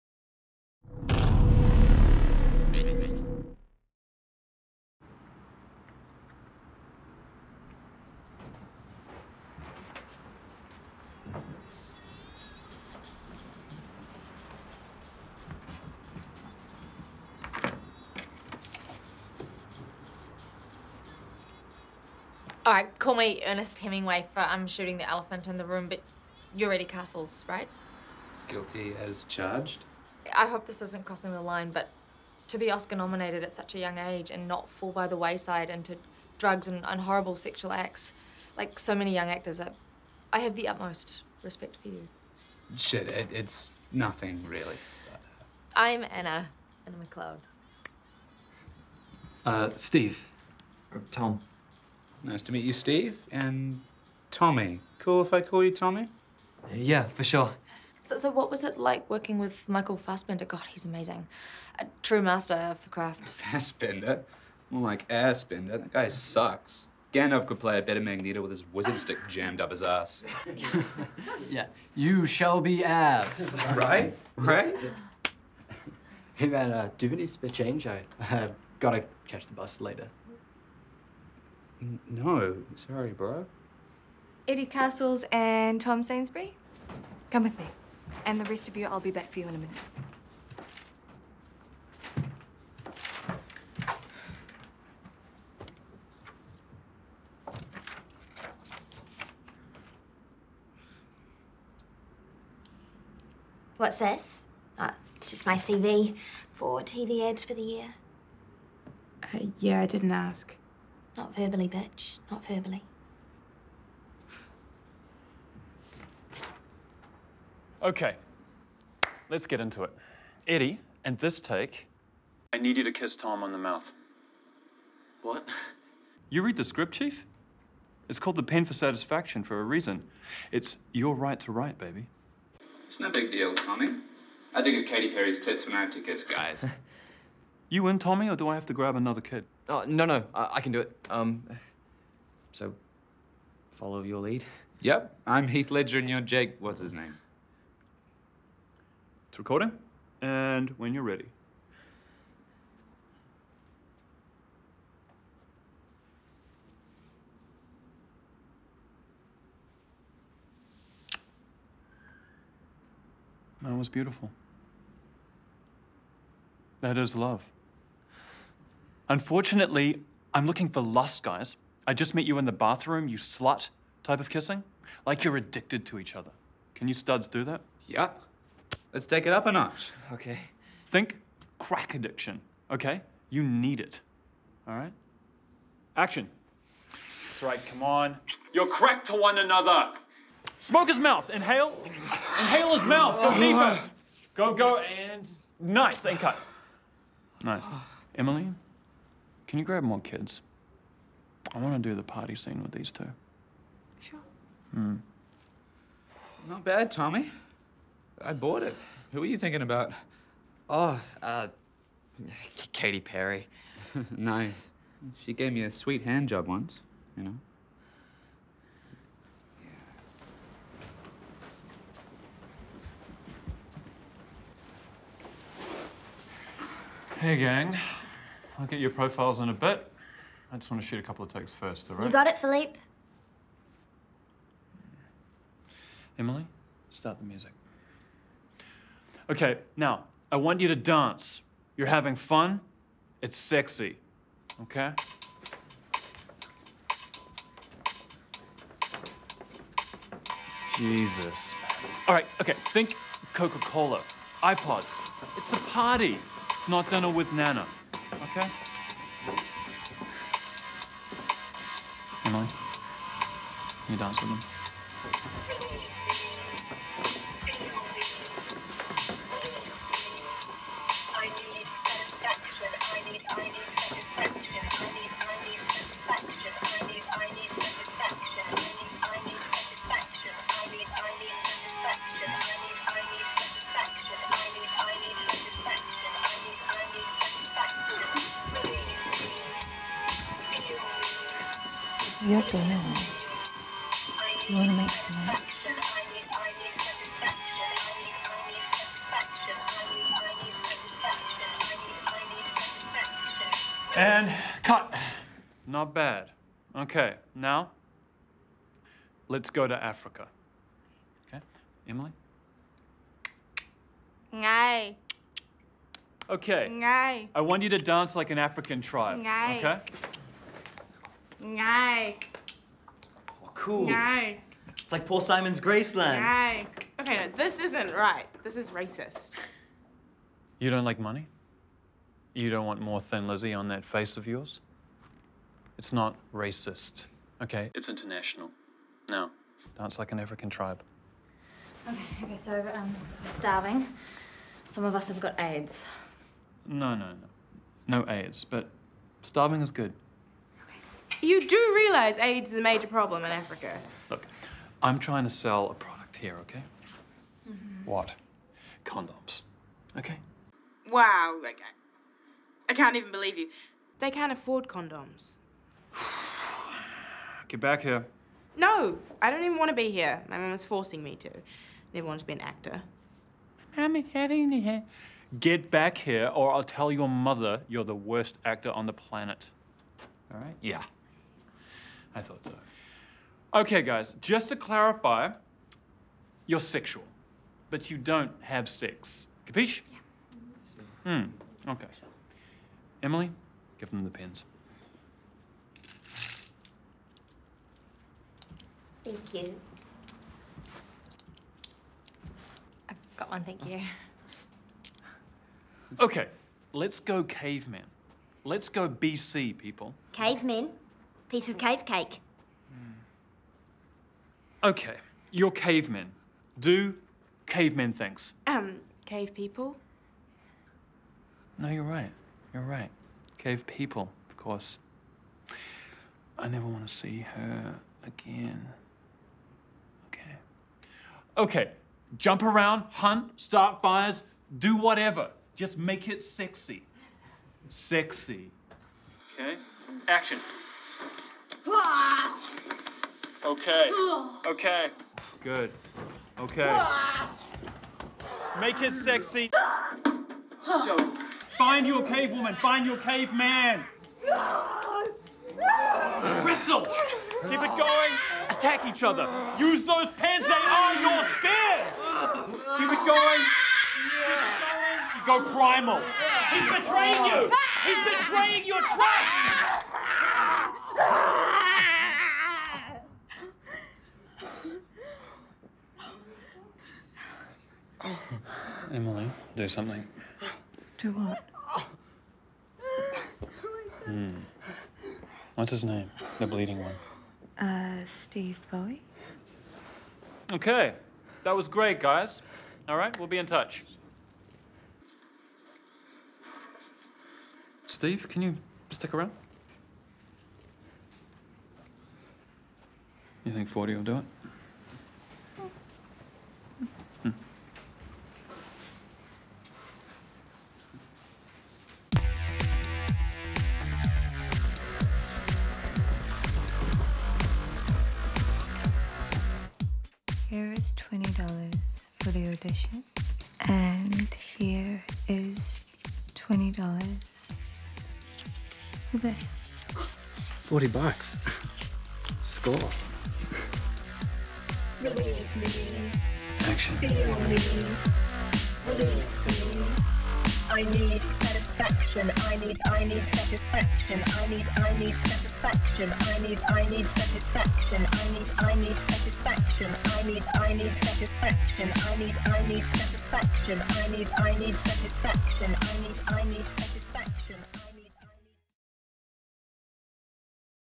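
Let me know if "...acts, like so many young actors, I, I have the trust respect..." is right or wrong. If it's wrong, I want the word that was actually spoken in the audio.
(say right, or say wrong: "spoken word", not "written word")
wrong: "utmost", not "trust".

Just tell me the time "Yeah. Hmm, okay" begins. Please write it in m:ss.
6:31.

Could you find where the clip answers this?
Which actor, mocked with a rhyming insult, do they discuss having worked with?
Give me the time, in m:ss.
0:59.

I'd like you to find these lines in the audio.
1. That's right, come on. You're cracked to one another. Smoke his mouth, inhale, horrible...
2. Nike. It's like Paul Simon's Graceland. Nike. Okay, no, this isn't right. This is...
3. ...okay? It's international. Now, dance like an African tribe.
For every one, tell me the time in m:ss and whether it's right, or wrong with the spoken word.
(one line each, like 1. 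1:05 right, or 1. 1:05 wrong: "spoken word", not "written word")
1. 3:07 wrong: "inhale", not "horrible"
2. 5:23 right
3. 5:37 right.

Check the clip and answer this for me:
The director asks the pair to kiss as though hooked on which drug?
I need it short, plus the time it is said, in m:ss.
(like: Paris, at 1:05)
Crack, at 3:01.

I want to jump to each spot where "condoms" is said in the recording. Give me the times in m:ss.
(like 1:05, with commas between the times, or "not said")
5:58, 6:04.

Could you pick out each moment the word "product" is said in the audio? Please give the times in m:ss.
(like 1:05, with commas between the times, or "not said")
5:55.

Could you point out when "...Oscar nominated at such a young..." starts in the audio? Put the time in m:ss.
0:32.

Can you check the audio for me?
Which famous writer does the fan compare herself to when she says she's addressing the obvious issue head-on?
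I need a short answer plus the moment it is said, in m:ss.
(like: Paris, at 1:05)
Ernest Hemingway, at 0:23.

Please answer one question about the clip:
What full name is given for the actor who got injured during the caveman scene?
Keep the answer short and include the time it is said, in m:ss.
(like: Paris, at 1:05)
Steve Bowie, at 8:08.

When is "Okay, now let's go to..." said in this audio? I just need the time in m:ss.
5:06.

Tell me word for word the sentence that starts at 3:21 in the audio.
I want to do the party scene with these two.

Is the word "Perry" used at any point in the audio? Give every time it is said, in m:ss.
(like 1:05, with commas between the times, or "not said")
2:15, 3:33.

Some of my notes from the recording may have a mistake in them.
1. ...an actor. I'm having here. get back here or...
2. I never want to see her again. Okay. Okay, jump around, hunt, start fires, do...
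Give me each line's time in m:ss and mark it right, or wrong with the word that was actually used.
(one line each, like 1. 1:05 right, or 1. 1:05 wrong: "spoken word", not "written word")
1. 6:12 right
2. 7:06 right.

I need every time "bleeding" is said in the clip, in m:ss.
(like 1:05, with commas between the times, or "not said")
8:06.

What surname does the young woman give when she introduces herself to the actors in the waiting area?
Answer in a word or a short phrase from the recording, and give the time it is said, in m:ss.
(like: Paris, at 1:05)
McLeod, at 0:47.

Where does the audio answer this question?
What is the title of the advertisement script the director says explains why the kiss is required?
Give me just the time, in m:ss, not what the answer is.
2:08.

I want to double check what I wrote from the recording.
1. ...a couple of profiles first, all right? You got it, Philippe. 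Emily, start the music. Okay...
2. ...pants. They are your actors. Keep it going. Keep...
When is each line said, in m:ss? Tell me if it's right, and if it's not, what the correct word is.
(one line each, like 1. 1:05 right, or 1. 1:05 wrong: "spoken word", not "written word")
1. 3:50 wrong: "takes", not "profiles"
2. 7:40 wrong: "spears", not "actors".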